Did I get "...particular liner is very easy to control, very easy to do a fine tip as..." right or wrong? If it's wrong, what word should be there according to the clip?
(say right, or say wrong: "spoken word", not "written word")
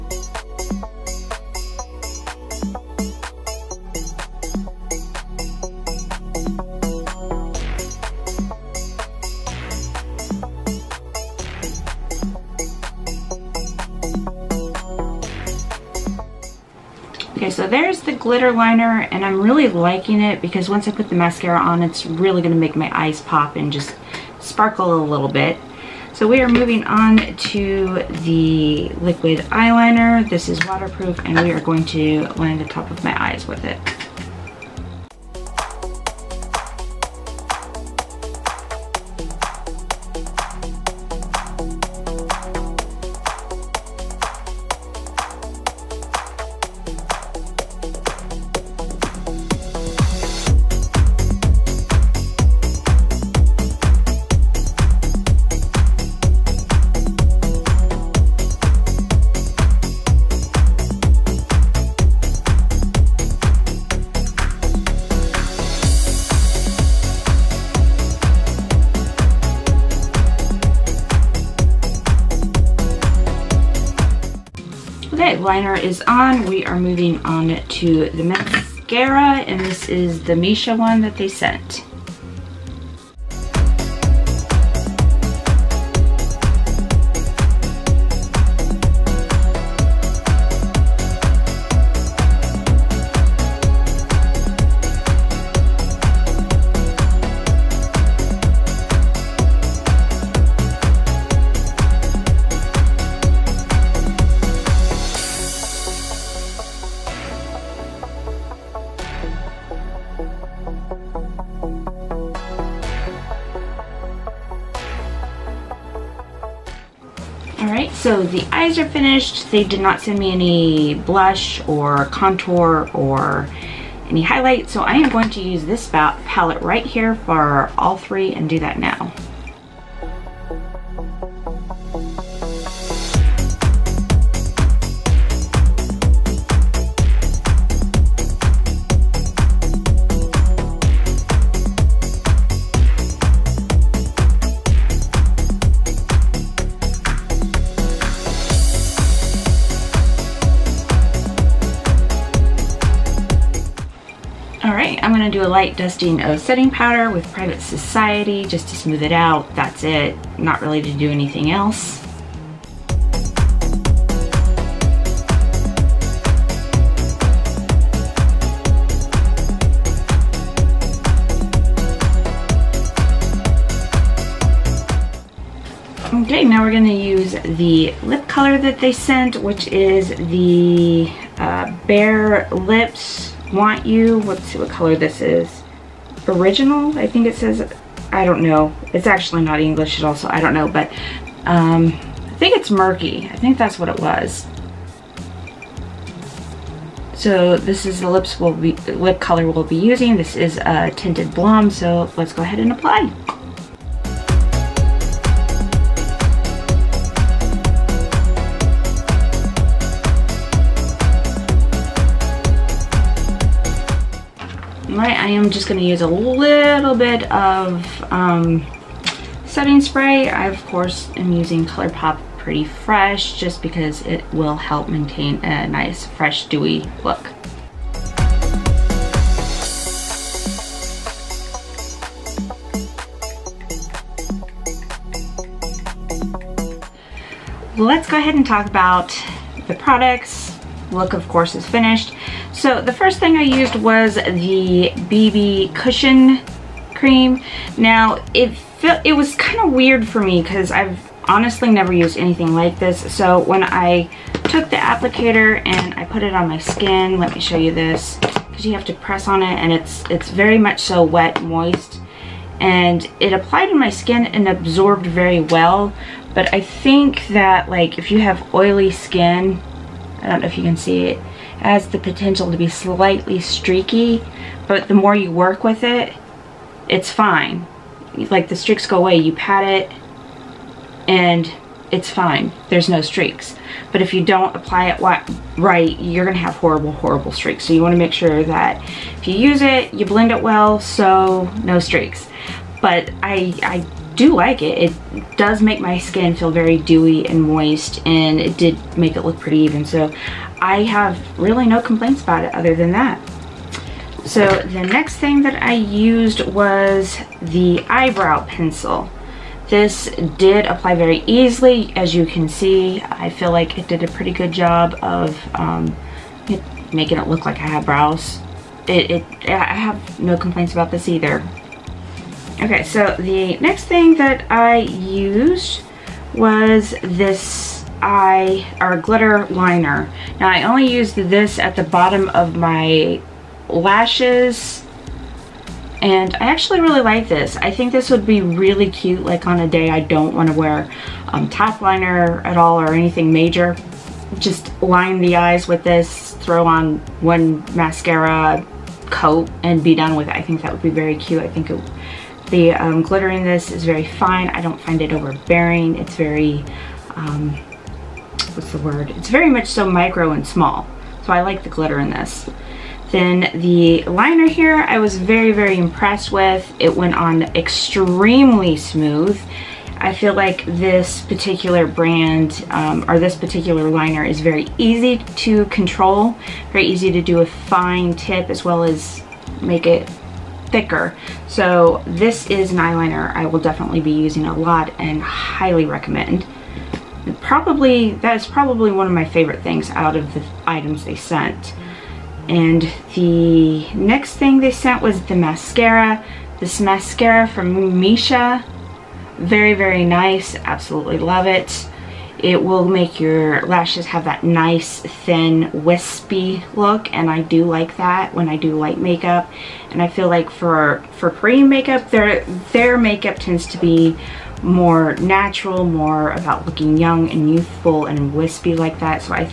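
right.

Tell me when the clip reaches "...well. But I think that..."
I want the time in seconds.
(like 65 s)
265 s.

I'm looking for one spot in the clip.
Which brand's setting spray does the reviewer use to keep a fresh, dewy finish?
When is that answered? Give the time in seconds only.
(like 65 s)
221 s.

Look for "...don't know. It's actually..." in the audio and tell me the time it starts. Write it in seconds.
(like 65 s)
188 s.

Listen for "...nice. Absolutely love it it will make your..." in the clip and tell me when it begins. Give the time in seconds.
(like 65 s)
400 s.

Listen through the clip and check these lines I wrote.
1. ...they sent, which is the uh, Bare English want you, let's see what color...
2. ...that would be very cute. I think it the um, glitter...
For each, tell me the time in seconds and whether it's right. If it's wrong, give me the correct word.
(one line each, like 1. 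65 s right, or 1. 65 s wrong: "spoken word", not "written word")
1. 178 s wrong: "Lips", not "English"
2. 350 s right.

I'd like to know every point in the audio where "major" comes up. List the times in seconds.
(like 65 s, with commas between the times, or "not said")
343 s.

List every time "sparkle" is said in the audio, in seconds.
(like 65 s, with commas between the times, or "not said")
24 s.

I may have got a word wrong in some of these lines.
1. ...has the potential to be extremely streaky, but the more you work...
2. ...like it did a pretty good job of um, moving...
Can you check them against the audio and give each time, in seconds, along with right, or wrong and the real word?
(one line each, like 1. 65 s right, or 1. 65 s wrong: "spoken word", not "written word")
1. 271 s wrong: "slightly", not "extremely"
2. 313 s wrong: "making", not "moving".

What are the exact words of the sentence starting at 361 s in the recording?
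So I like the glitter in this.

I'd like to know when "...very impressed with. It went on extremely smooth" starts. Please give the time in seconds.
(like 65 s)
365 s.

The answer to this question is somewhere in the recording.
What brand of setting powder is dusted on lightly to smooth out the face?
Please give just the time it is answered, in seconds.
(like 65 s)
157 s.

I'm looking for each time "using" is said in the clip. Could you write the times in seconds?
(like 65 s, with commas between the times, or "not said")
199 s, 221 s, 384 s.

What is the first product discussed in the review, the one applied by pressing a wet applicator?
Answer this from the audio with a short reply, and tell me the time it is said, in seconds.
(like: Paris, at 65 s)
BB Cushion Cream, at 245 s.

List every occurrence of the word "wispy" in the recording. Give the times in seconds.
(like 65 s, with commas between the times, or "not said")
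405 s, 418 s.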